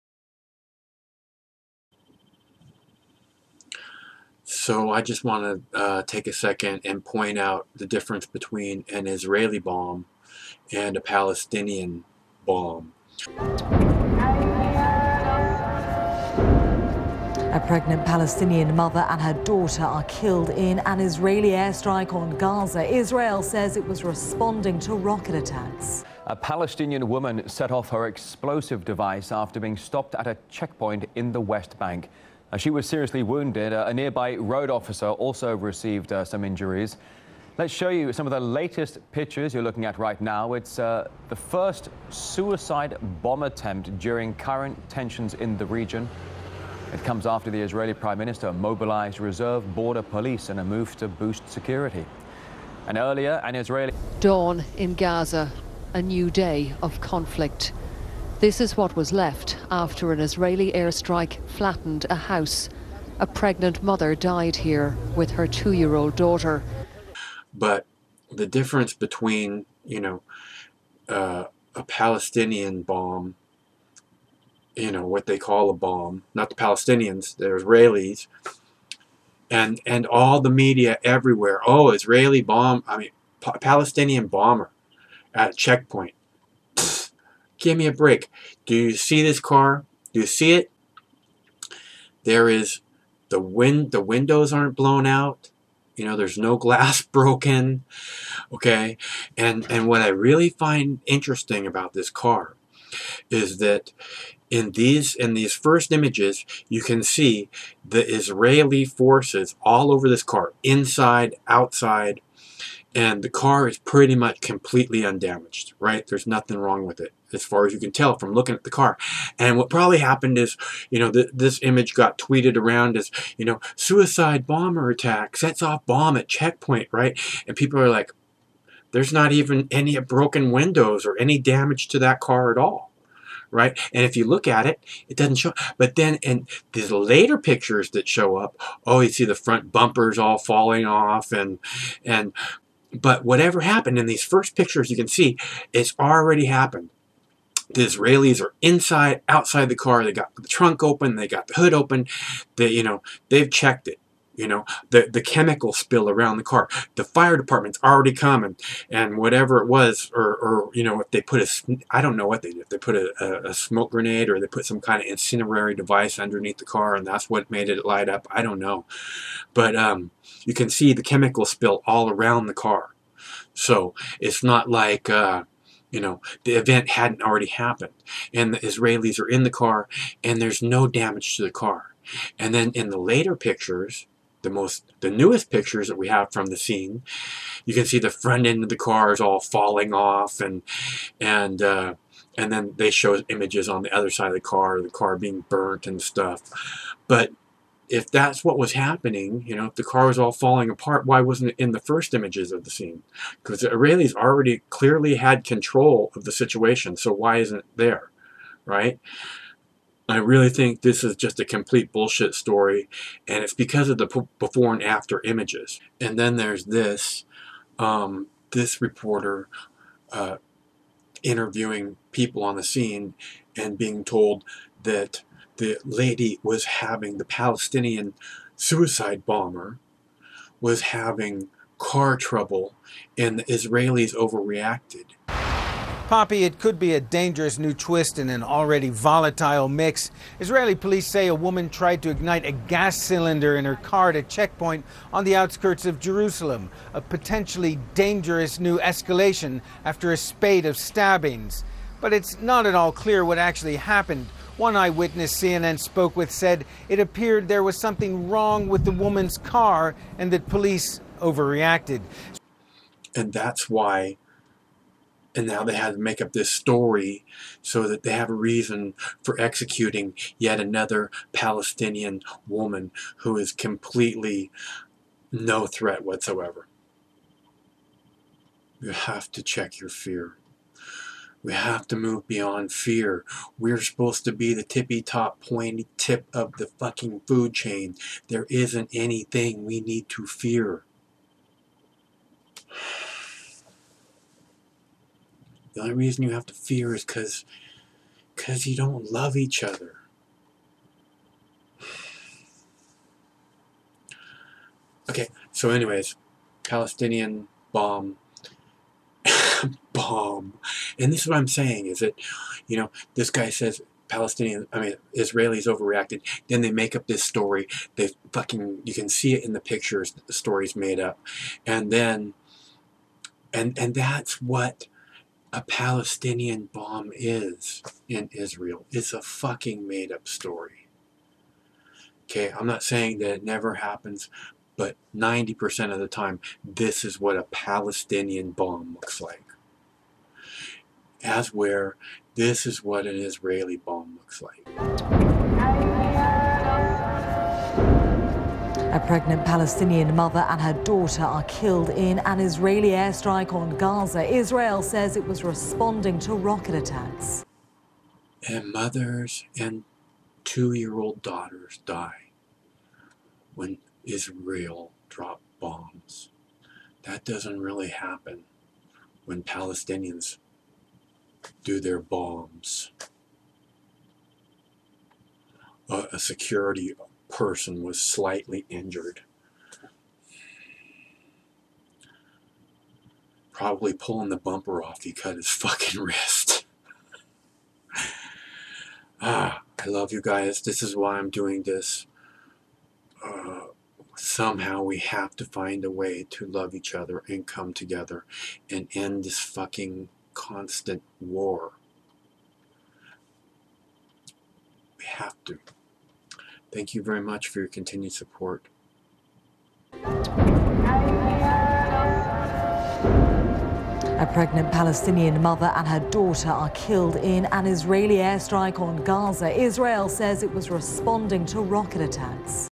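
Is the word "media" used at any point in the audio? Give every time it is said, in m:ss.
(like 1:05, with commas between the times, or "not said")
1:20.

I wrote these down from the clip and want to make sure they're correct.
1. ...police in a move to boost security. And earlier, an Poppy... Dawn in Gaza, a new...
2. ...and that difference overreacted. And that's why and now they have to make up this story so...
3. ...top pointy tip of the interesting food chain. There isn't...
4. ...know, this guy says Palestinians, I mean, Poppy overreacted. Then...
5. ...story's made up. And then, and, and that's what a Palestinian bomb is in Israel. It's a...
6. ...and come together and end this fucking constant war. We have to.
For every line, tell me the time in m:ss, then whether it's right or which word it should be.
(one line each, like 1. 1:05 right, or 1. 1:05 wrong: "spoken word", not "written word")
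1. 0:50 wrong: "Israeli", not "Poppy"
2. 4:20 wrong: "police", not "difference"
3. 4:45 wrong: "fucking", not "interesting"
4. 5:12 wrong: "Israelis", not "Poppy"
5. 5:20 right
6. 6:37 right.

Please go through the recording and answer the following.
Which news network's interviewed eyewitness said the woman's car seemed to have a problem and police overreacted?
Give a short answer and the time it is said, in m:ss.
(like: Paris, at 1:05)
CNN, at 4:15.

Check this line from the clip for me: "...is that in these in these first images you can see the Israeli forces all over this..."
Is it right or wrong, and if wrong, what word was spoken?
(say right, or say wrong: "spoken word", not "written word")
right.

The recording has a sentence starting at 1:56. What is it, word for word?
There's nothing wrong with it as far as you can tell from looking at the car.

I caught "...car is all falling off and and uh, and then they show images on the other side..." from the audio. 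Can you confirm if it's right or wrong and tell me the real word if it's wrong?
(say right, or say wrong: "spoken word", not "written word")
right.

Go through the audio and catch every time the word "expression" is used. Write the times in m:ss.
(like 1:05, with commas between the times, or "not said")
not said.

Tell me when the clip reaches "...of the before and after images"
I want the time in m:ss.
3:33.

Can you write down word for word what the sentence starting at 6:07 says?
That doesn't really happen when Palestinians do their bombs.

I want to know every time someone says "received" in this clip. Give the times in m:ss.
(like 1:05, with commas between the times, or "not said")
0:35.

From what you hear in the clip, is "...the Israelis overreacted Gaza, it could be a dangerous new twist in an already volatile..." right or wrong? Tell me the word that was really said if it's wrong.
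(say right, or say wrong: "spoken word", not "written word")
wrong: "Poppy", not "Gaza".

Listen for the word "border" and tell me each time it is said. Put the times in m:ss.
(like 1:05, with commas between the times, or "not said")
0:49.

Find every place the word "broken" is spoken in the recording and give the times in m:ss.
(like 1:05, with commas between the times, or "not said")
1:37, 2:09.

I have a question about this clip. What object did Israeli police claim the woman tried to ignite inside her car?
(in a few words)
Gas cylinder.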